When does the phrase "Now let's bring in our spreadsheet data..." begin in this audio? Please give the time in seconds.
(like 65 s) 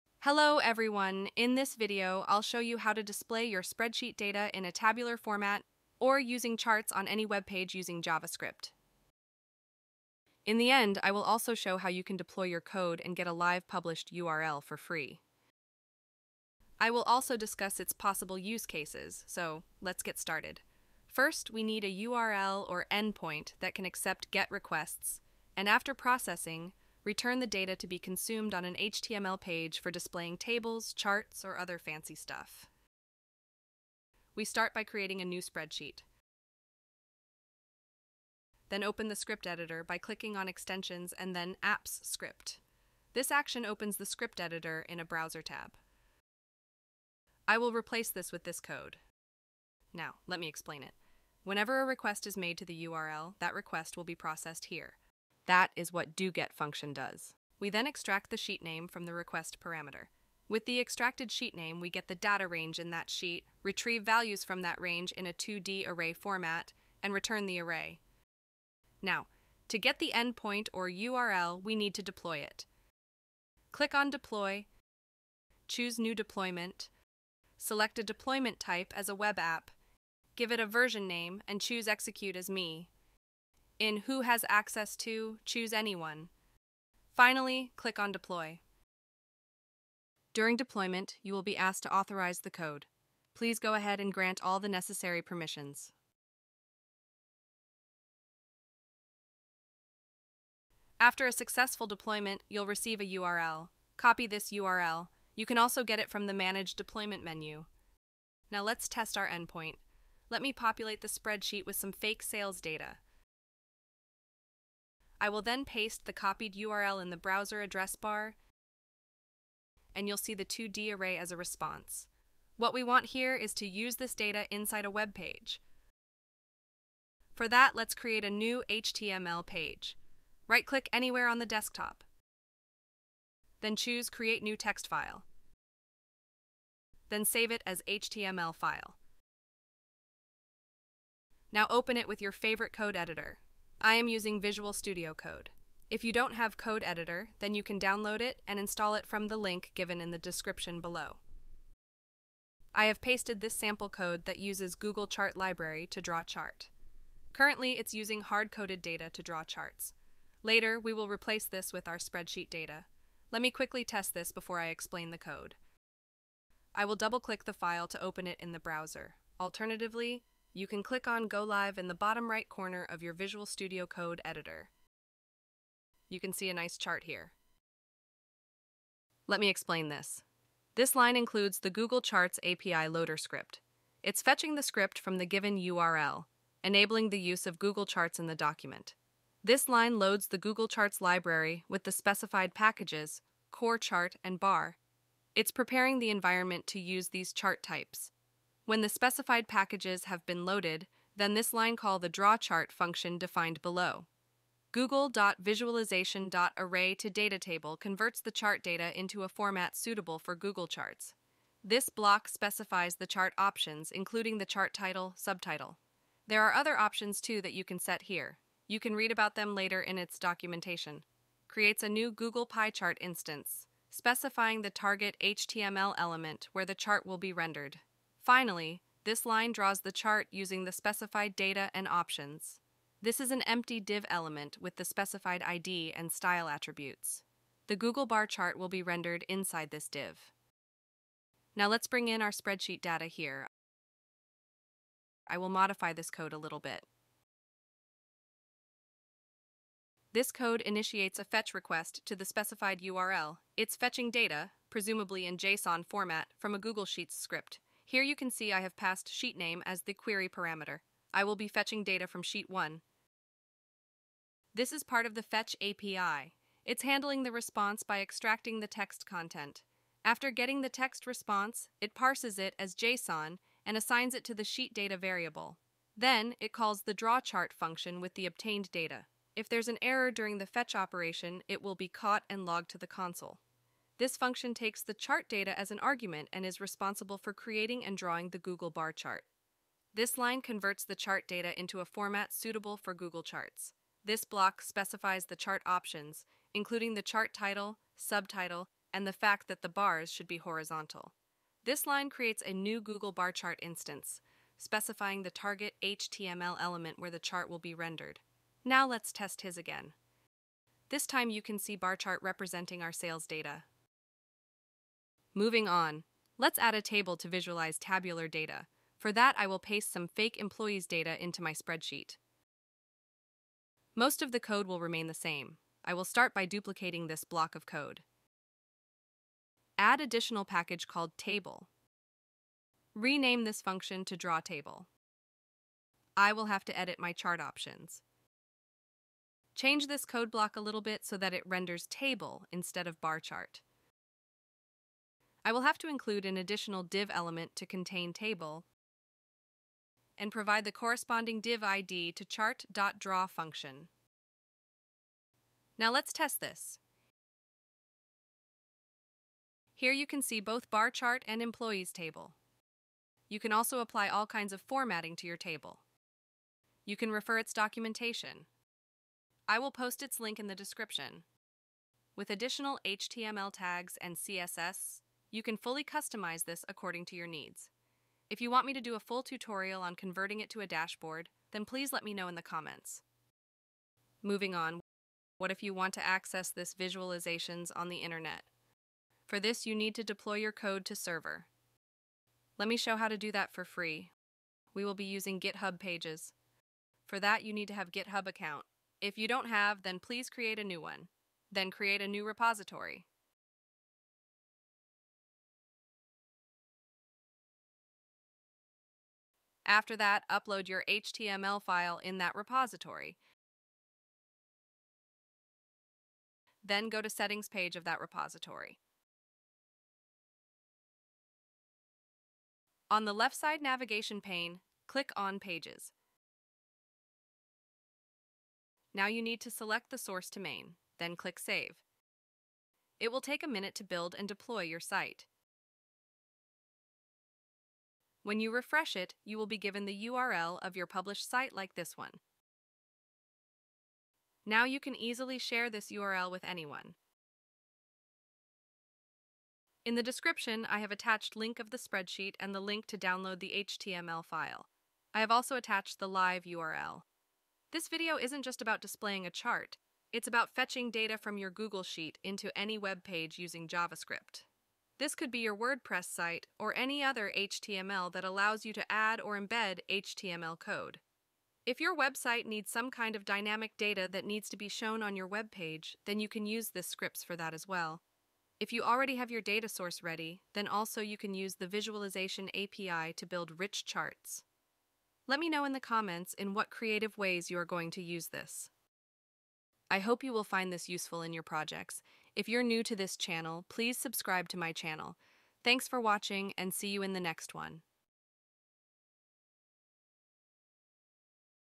241 s.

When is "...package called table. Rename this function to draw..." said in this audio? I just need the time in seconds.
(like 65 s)
330 s.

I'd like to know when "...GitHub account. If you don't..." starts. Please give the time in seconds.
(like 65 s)
397 s.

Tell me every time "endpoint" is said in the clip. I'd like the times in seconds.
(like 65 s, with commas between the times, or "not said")
22 s, 70 s, 109 s.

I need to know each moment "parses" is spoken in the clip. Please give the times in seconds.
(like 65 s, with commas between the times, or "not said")
271 s.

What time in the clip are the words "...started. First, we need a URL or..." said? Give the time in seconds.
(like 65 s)
20 s.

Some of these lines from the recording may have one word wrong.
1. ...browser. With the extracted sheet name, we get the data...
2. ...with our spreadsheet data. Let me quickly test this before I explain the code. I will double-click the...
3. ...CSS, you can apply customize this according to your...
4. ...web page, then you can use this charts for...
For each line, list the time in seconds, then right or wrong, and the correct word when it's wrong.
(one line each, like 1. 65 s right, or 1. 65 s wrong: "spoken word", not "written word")
1. 59 s wrong: "parameter", not "browser"
2. 161 s right
3. 374 s wrong: "fully", not "apply"
4. 475 s wrong: "scripts", not "charts".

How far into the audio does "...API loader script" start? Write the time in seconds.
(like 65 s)
182 s.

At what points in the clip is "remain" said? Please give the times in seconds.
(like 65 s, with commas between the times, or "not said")
324 s.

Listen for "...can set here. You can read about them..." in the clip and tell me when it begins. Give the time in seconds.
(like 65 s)
217 s.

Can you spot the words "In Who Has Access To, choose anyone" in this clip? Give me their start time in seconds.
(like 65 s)
83 s.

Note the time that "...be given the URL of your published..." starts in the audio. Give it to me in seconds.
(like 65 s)
439 s.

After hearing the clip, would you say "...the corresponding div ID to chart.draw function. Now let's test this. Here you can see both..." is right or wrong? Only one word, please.
right.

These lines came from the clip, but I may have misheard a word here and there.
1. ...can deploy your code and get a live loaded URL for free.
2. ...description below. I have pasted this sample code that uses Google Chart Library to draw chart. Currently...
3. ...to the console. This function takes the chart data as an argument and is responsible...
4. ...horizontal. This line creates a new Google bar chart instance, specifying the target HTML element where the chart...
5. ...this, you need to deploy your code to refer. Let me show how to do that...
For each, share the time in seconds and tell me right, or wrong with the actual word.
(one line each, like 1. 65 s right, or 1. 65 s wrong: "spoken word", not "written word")
1. 12 s wrong: "published", not "loaded"
2. 150 s right
3. 282 s right
4. 300 s right
5. 389 s wrong: "server", not "refer".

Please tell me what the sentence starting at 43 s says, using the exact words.
This action opens the script editor in a browser tab.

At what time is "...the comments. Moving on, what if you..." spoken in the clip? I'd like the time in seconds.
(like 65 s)
382 s.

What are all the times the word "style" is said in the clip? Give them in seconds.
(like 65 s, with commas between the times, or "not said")
236 s.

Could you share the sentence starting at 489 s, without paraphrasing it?
I hope you will find this useful in your projects if you're new to this channel, please subscribe to my channel.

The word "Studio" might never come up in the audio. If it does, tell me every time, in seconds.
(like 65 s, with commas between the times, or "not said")
144 s, 173 s.